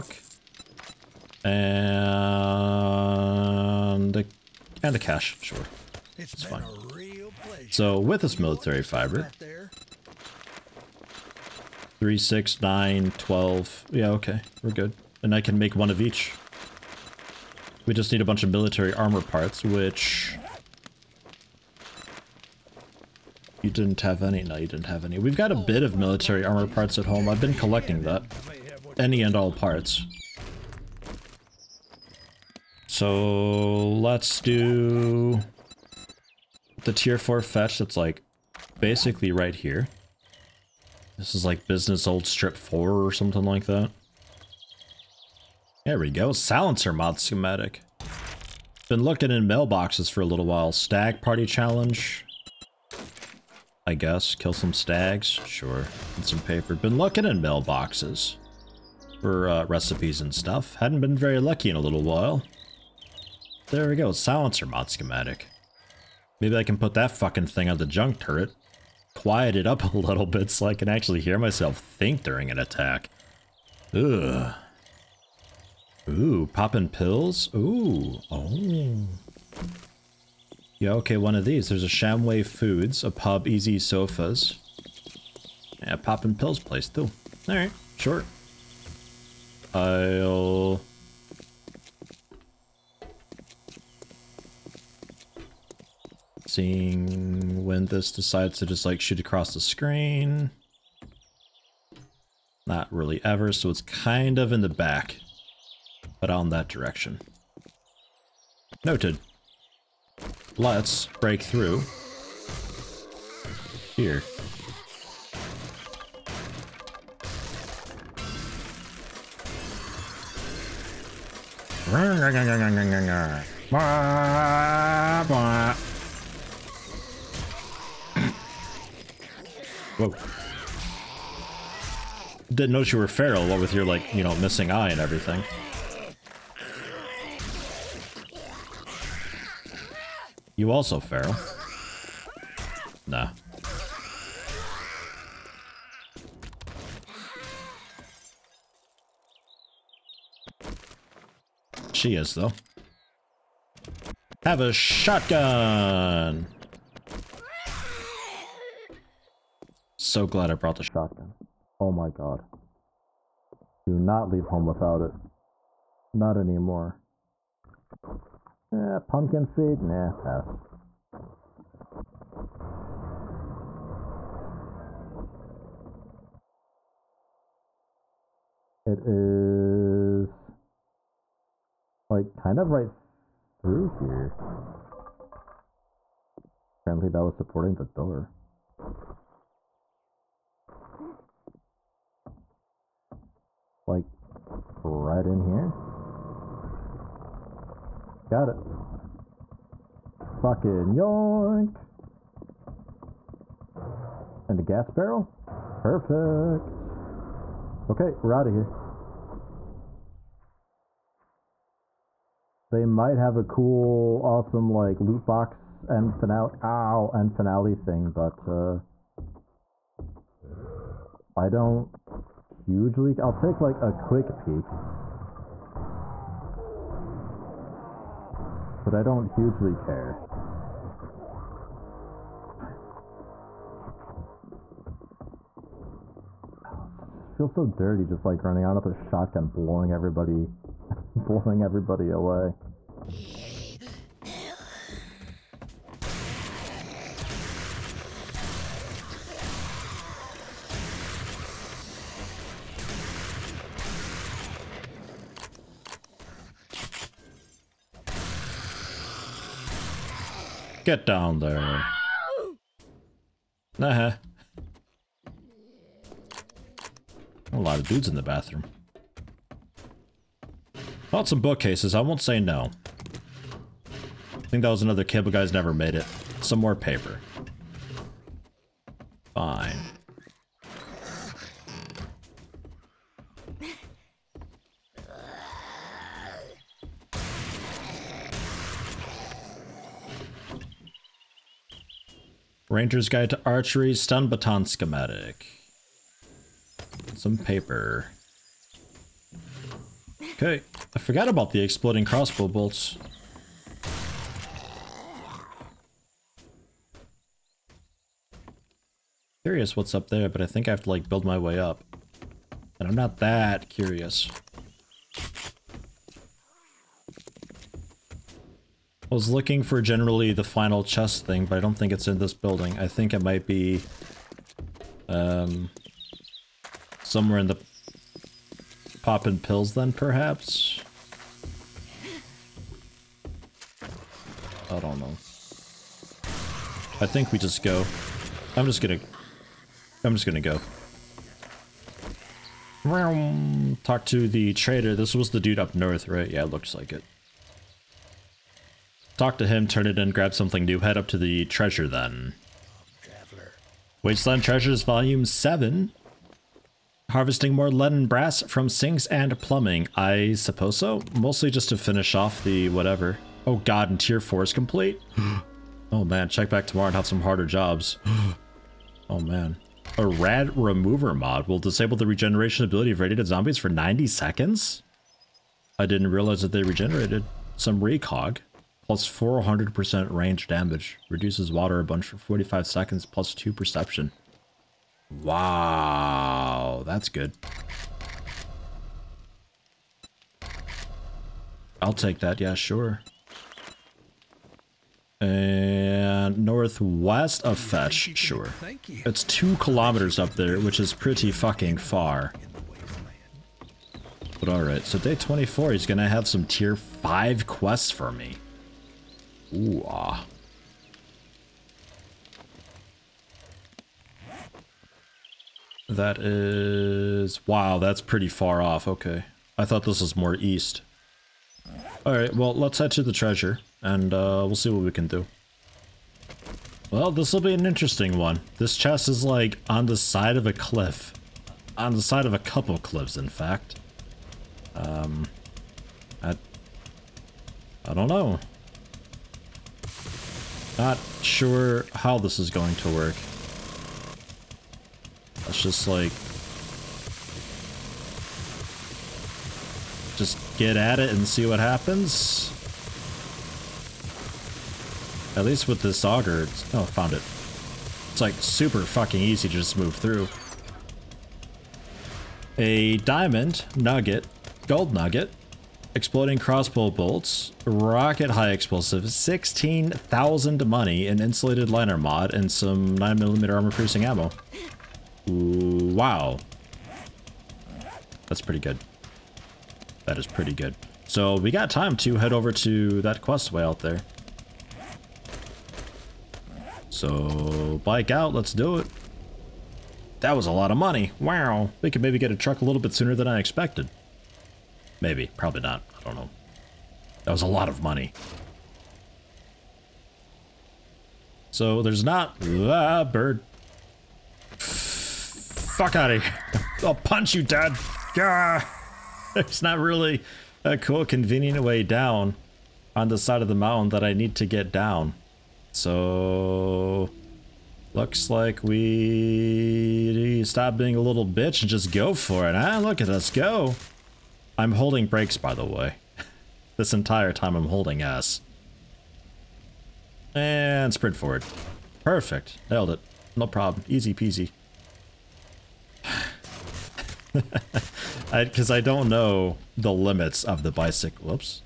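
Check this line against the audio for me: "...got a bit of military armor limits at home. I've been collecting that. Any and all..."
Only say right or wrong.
wrong.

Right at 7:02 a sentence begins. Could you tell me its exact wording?
Alright, well, let's head to the treasure, and uh, we'll see what we can do.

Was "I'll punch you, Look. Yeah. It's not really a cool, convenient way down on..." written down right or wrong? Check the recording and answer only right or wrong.
wrong.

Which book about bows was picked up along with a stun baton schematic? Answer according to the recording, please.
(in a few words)
Ranger's Guide to Archery.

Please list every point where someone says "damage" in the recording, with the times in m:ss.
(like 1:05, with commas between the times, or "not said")
6:20.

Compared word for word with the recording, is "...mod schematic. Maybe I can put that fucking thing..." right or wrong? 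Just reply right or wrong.
right.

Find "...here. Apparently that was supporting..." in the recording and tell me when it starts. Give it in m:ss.
3:03.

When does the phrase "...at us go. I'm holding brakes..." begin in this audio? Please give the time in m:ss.
8:43.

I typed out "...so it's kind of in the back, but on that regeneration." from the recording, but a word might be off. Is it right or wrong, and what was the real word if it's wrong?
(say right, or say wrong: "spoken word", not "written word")
wrong: "direction", not "regeneration".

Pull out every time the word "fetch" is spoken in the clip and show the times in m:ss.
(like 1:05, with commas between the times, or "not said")
0:37, 6:37.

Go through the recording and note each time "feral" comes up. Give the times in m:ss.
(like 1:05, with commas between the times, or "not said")
2:13, 2:20.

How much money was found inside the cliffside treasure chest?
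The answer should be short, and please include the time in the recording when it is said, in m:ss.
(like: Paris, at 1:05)
16,000, at 7:49.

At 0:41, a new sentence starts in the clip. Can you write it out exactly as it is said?
This is like business old strip 4 or something like that.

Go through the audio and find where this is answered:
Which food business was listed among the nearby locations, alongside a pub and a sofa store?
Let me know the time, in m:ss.
1:21.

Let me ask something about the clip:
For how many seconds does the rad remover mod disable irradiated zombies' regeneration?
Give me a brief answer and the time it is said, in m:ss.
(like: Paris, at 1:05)
90, at 6:13.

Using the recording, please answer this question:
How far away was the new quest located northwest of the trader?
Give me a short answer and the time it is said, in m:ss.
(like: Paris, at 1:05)
2 kilometers, at 6:39.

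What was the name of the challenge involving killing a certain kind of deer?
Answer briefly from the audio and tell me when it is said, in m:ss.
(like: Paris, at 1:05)
Stag party challenge, at 0:50.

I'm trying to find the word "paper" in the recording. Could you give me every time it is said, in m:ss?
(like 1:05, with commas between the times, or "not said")
0:56, 4:36, 4:57.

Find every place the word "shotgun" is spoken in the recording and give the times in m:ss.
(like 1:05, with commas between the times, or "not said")
2:34, 2:40, 3:58.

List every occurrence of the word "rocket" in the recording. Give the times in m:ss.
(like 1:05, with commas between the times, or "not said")
7:47.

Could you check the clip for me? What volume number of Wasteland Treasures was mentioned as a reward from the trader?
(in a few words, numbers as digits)
7.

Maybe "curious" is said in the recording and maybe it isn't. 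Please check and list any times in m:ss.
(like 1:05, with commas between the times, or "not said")
5:09, 5:13.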